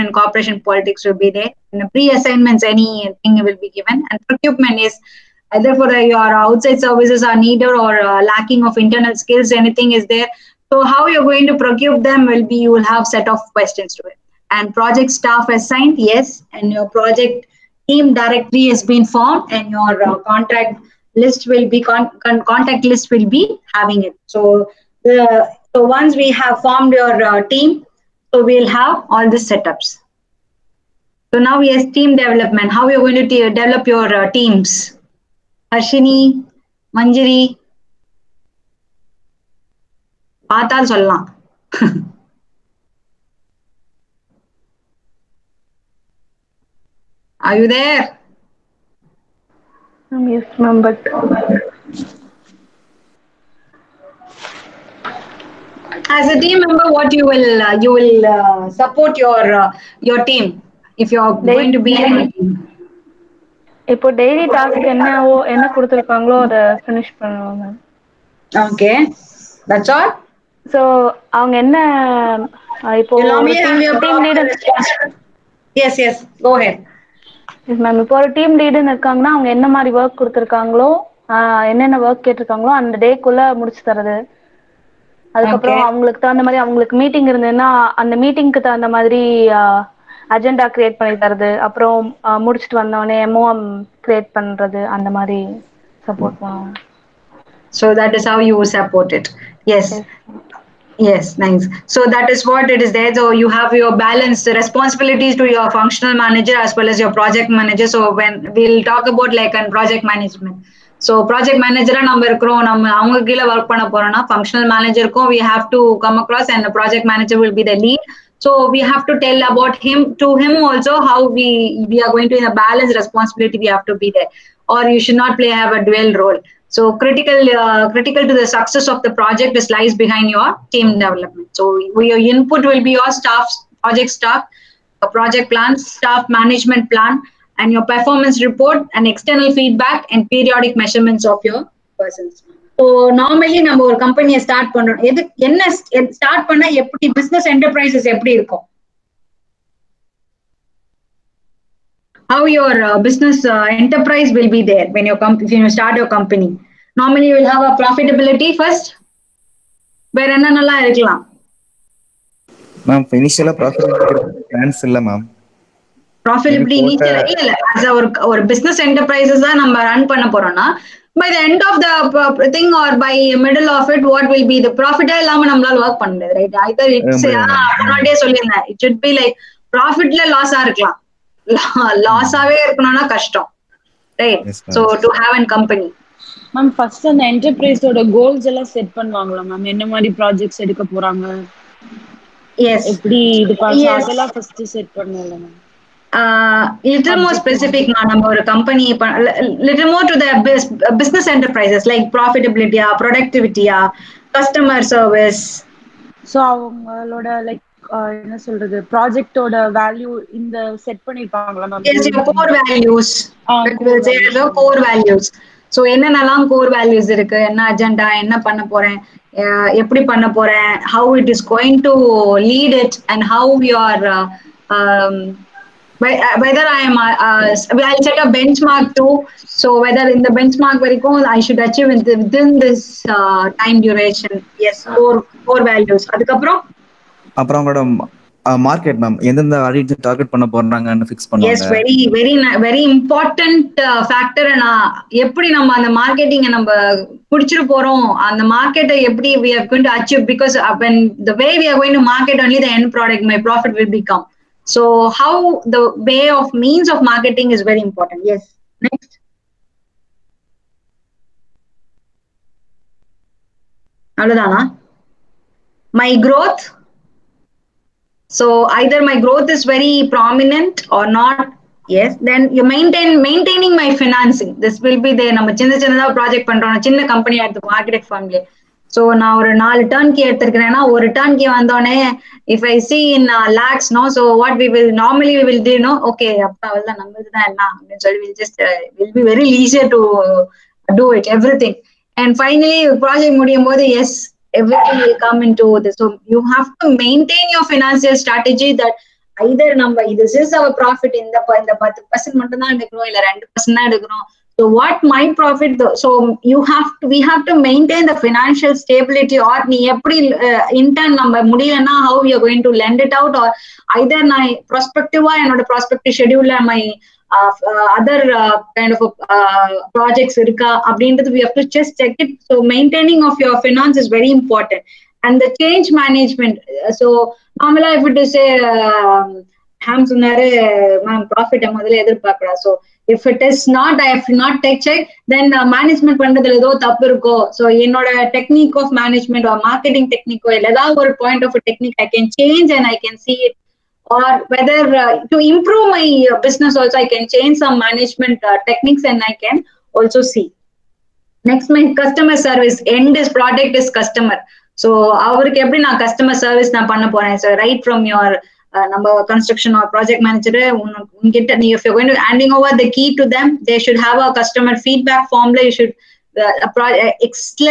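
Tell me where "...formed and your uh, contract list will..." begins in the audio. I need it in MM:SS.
00:19.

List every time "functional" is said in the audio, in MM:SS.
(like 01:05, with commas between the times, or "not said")
01:45, 01:54.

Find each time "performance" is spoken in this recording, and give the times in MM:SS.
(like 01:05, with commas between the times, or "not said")
02:17.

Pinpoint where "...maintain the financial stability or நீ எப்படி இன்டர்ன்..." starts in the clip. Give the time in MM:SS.
05:07.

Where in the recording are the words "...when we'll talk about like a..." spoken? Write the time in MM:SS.
01:48.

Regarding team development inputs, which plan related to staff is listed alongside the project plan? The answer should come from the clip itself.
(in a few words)
staff management plan.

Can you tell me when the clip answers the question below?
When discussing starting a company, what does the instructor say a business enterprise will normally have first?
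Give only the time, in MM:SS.
02:37.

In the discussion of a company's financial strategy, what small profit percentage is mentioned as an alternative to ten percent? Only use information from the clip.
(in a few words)
2 percent.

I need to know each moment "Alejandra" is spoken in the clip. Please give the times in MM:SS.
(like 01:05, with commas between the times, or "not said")
not said.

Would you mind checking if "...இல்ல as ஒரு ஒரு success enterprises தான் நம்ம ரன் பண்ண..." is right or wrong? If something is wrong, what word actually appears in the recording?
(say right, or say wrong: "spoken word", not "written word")
wrong: "business", not "success".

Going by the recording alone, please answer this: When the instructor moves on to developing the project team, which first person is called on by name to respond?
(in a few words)
Harshini.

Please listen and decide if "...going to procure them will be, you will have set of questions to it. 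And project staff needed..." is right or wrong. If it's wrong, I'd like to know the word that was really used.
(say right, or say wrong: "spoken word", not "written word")
wrong: "assigned", not "needed".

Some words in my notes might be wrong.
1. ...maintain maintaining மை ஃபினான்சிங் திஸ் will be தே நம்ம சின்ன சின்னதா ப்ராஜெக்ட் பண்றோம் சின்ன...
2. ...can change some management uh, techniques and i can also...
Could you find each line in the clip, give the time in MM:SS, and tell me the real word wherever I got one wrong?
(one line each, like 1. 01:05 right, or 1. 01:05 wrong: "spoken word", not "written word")
1. 04:32 right
2. 05:47 right.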